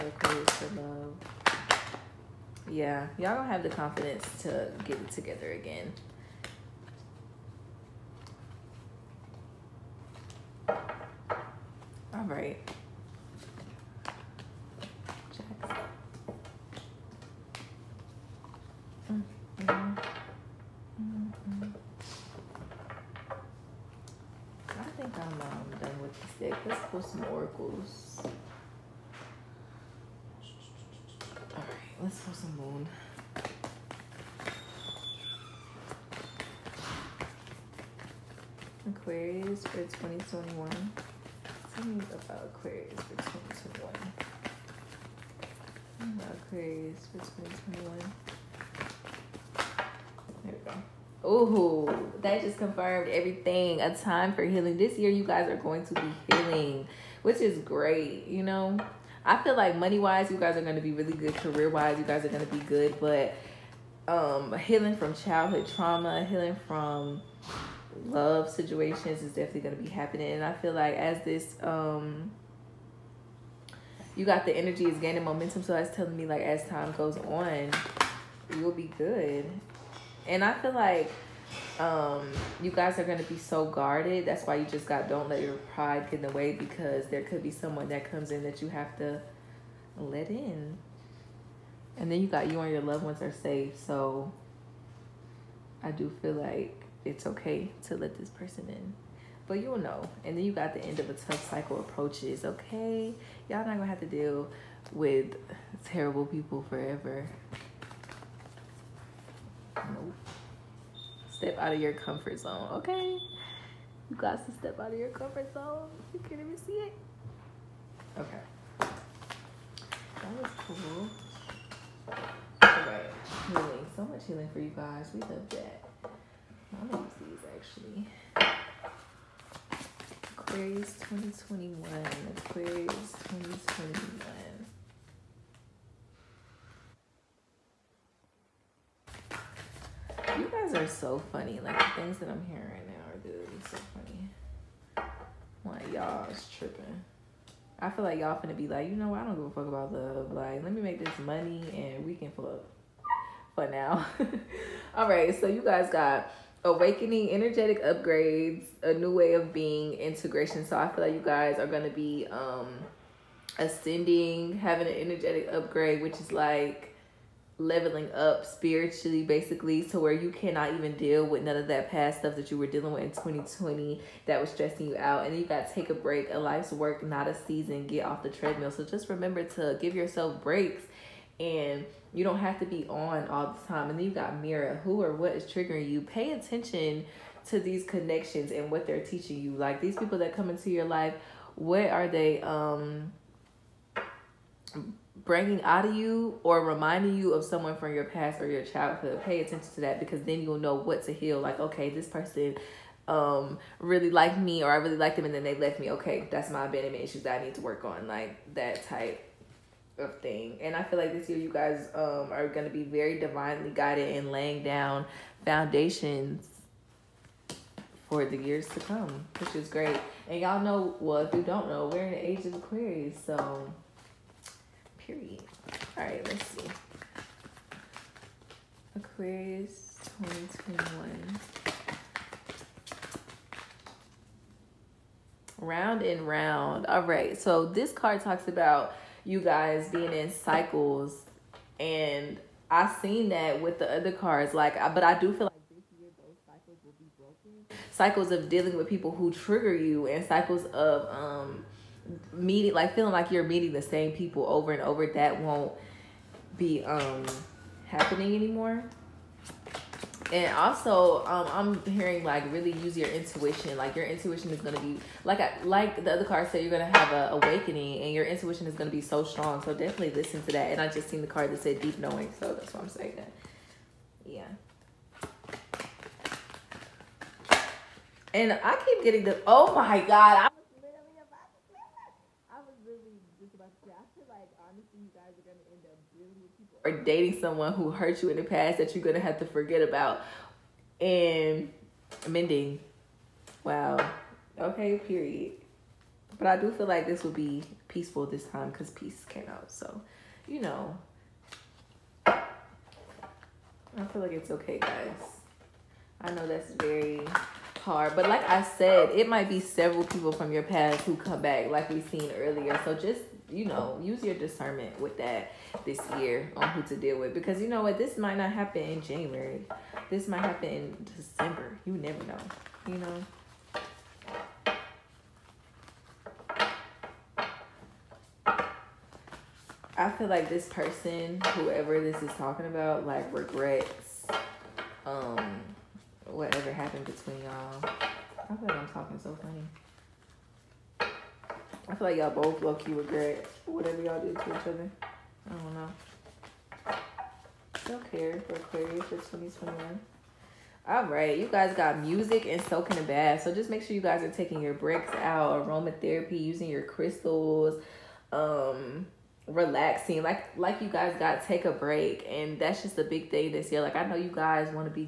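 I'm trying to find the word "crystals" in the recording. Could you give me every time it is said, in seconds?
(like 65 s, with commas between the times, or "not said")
356 s.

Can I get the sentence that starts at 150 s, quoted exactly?
Like, let me make this money and we can fuck for now.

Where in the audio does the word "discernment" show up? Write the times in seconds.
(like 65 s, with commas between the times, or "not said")
314 s.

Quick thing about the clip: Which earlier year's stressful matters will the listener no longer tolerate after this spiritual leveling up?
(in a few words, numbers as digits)
2020.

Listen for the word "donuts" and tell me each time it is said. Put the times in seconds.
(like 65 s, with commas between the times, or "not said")
not said.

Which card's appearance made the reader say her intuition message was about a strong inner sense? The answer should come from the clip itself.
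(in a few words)
Deep knowing.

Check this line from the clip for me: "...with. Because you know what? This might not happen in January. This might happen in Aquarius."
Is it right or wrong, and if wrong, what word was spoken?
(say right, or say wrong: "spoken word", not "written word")
wrong: "December", not "Aquarius".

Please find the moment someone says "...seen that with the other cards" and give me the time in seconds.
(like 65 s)
243 s.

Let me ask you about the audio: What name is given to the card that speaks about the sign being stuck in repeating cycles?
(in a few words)
Round and round.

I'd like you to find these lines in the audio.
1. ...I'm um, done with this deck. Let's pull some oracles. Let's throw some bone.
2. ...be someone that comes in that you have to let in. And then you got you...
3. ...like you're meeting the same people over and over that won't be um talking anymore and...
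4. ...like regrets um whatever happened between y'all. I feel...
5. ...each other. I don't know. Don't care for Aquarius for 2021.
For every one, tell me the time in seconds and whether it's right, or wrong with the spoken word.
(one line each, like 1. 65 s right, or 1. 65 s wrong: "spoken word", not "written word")
1. 25 s right
2. 87 s right
3. 253 s wrong: "happening", not "talking"
4. 333 s right
5. 344 s right.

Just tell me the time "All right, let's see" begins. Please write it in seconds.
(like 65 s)
225 s.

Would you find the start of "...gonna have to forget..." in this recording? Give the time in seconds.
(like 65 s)
289 s.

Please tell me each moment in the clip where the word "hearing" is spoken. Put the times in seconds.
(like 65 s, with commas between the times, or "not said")
142 s, 261 s.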